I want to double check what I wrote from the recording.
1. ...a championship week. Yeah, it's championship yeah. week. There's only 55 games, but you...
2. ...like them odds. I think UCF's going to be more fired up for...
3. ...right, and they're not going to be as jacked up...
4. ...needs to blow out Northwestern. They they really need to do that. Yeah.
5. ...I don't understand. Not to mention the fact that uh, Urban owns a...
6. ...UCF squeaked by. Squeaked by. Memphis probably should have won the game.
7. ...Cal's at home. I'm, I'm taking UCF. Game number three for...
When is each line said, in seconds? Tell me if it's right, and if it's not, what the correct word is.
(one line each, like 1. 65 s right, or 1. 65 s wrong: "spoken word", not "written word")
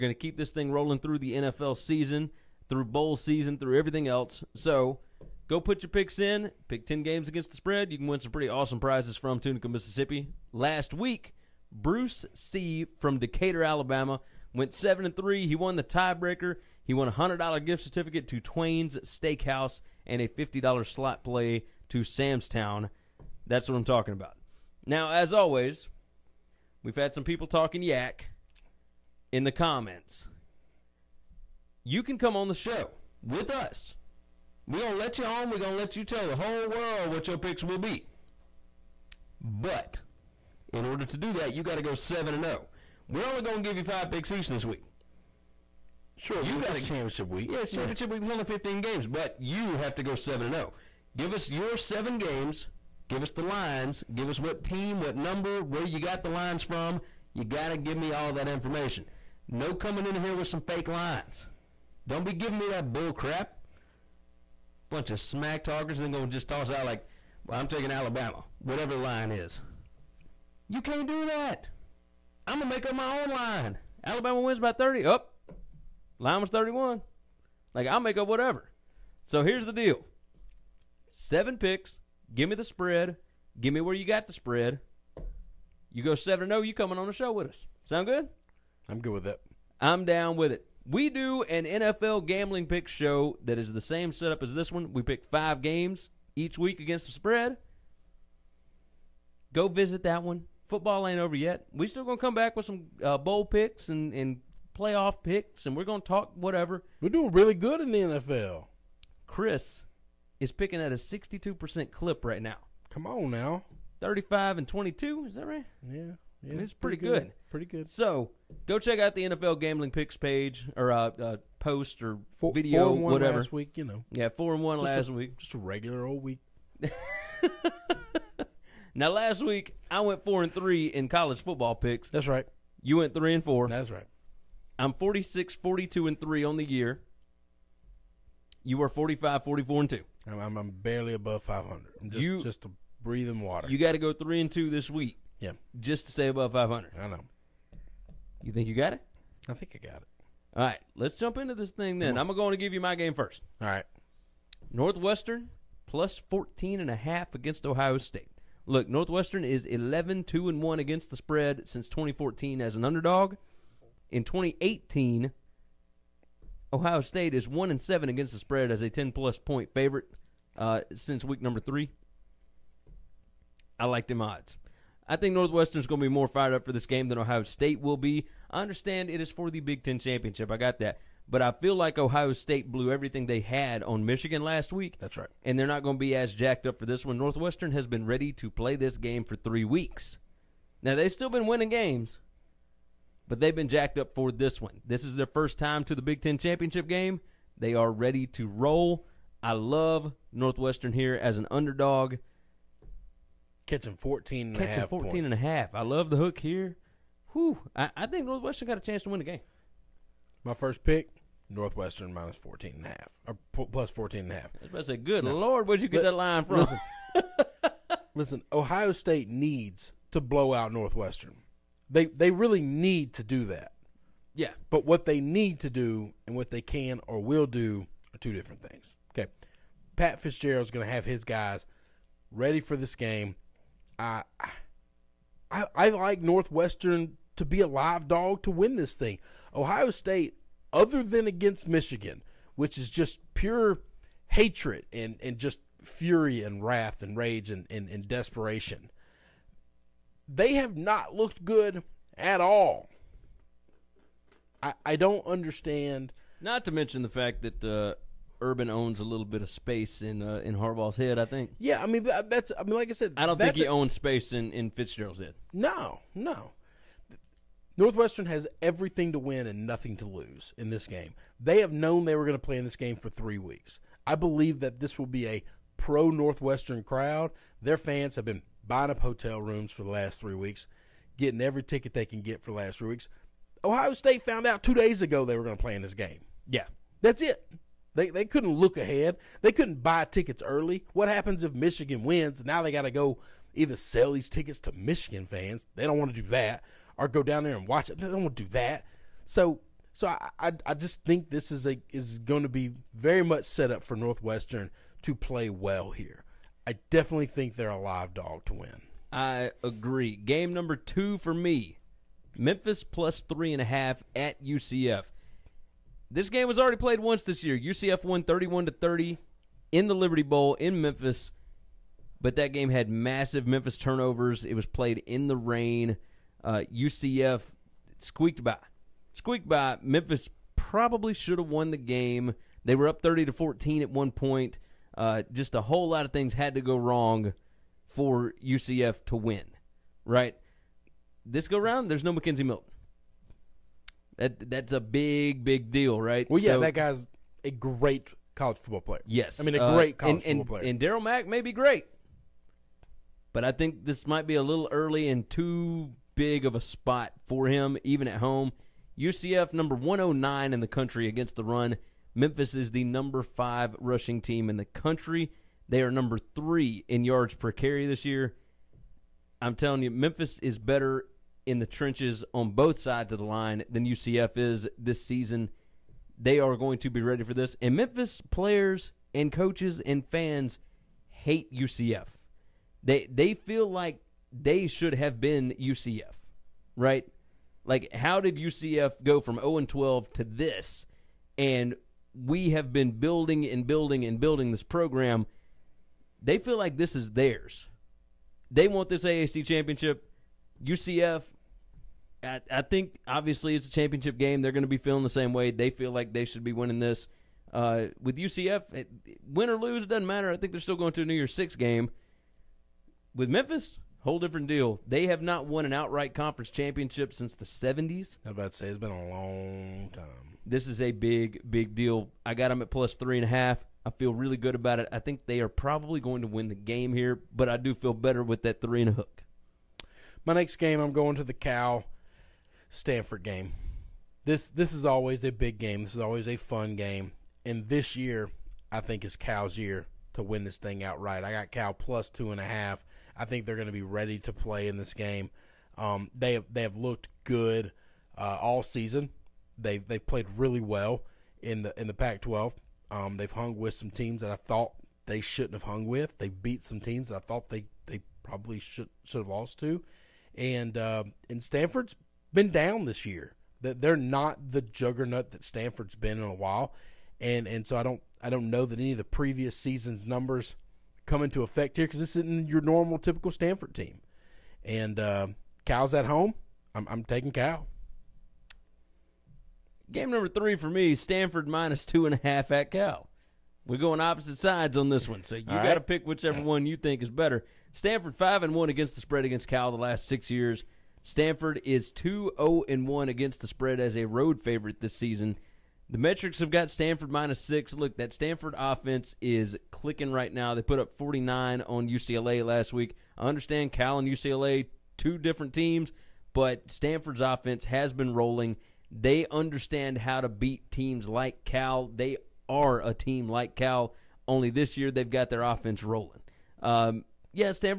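1. 46 s wrong: "15", not "55"
2. 173 s wrong: "Northwestern", not "UCF"
3. 185 s right
4. 219 s right
5. 254 s right
6. 326 s right
7. 475 s wrong: "Cal", not "UCF".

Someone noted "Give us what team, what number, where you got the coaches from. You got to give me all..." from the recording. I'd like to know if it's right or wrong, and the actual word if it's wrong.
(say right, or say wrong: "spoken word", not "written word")
wrong: "lines", not "coaches".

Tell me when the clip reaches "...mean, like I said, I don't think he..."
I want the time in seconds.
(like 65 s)
262 s.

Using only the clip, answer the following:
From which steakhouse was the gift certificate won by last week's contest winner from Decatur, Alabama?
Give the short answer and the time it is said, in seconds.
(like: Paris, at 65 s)
Twain's Steakhouse, at 18 s.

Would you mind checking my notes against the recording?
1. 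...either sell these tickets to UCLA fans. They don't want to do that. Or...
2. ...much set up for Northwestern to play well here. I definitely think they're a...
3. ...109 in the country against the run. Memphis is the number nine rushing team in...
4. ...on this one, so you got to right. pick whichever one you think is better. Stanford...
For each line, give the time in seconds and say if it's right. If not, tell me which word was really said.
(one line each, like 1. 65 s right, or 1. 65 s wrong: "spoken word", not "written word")
1. 293 s wrong: "Michigan", not "UCLA"
2. 303 s right
3. 359 s wrong: "five", not "nine"
4. 484 s right.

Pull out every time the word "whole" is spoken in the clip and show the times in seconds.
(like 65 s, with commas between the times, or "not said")
36 s, 335 s, 414 s.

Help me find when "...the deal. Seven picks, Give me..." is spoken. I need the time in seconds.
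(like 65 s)
79 s.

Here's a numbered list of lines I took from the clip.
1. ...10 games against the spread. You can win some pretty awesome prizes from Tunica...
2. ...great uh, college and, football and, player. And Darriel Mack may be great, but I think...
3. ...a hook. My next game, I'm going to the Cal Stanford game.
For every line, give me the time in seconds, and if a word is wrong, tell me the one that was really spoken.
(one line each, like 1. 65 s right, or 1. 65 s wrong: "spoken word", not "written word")
1. 6 s right
2. 349 s right
3. 428 s right.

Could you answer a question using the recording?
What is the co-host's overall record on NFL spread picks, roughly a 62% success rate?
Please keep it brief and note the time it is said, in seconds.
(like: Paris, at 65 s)
35-22, at 114 s.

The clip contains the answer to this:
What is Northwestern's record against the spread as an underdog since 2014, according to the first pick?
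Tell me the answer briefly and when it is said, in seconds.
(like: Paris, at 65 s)
11-2-1, at 159 s.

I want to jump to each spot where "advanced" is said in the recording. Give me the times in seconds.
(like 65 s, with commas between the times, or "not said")
not said.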